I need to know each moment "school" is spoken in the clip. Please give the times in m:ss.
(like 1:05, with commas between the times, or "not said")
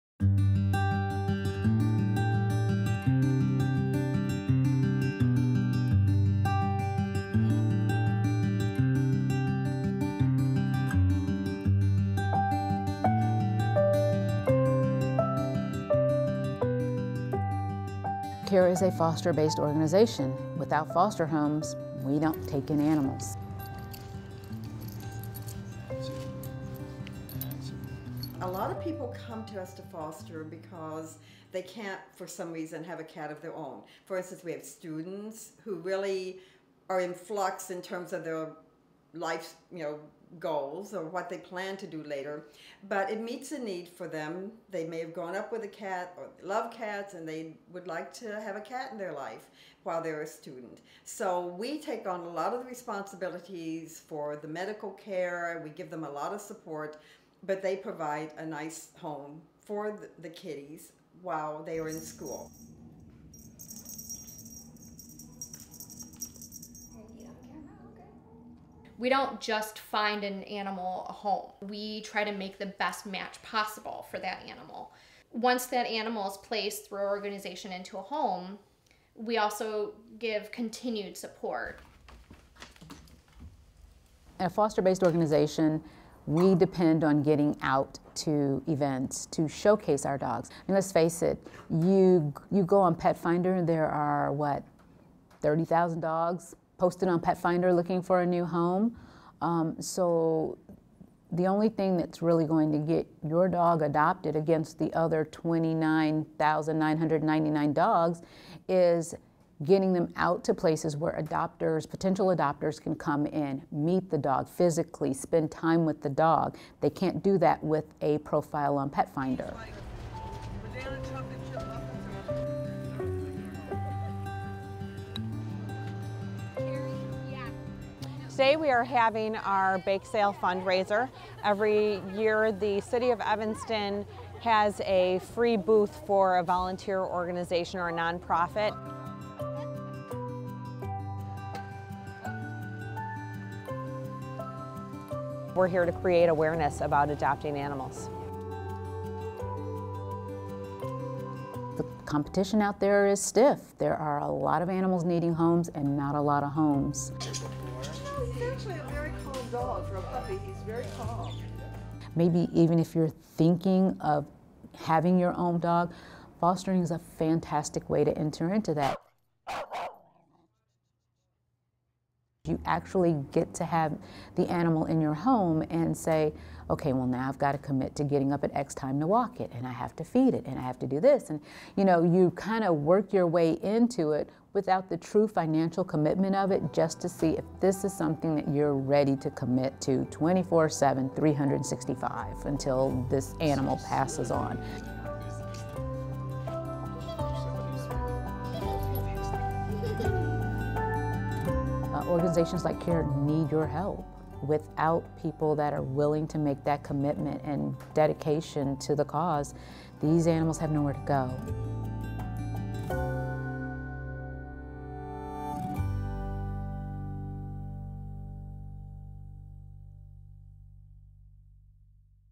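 1:01.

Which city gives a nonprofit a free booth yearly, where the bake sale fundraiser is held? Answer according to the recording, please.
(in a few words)
Evanston.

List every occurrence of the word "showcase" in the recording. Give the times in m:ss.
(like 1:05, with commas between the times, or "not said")
1:29.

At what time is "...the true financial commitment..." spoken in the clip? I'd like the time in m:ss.
3:04.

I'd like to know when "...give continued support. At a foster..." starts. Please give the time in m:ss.
1:20.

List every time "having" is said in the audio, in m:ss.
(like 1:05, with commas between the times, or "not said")
2:08, 2:44.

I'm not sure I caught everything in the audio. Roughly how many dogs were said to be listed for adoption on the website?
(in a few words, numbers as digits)
30,000.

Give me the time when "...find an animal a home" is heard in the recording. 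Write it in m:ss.
1:09.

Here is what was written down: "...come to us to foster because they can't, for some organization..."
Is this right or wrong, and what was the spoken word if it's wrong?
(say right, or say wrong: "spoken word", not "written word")
wrong: "reason", not "organization".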